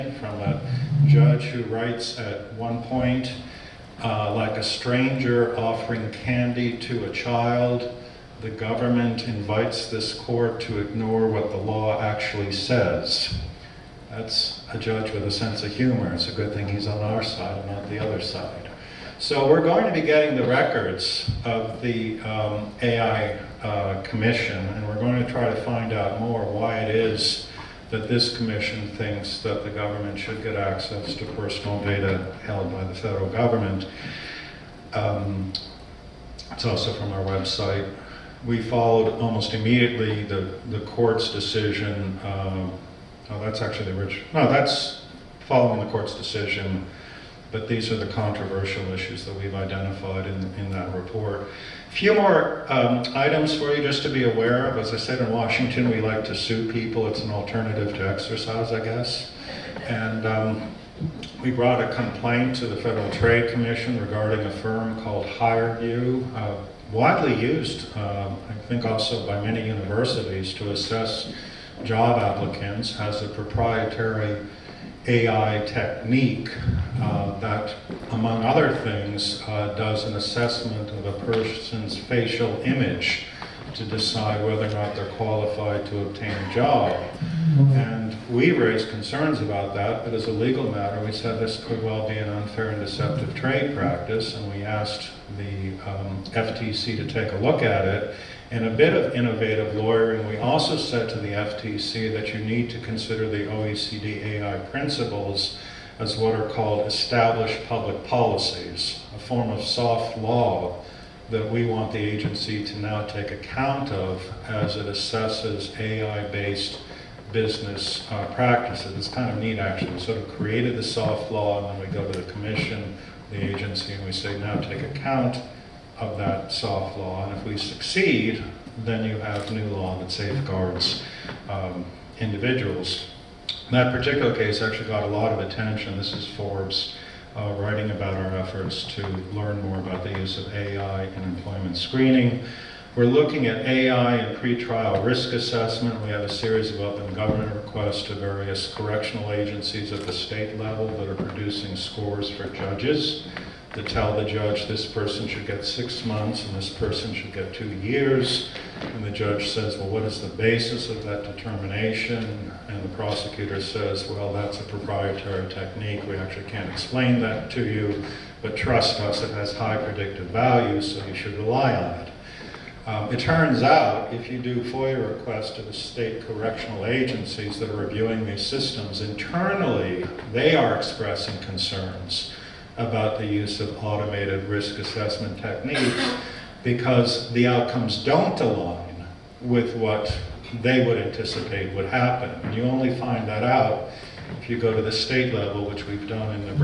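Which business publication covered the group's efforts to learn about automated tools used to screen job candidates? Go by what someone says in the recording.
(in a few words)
Forbes.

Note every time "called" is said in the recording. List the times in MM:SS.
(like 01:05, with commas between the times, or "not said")
01:05, 01:46.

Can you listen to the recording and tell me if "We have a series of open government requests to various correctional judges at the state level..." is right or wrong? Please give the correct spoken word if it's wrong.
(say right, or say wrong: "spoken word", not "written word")
wrong: "agencies", not "judges".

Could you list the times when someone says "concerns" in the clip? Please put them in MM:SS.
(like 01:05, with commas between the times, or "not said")
01:28, 03:01.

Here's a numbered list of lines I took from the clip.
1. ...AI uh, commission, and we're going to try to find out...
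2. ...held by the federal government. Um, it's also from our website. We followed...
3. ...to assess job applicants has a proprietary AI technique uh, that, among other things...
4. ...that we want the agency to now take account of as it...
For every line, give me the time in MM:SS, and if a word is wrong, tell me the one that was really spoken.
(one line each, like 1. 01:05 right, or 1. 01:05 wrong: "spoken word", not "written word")
1. 00:22 right
2. 00:32 right
3. 01:10 right
4. 01:51 right.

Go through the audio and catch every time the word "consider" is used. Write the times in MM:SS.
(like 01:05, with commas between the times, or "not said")
01:42.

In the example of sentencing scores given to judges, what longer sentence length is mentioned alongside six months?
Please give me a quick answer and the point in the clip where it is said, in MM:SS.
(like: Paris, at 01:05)
2 years, at 02:37.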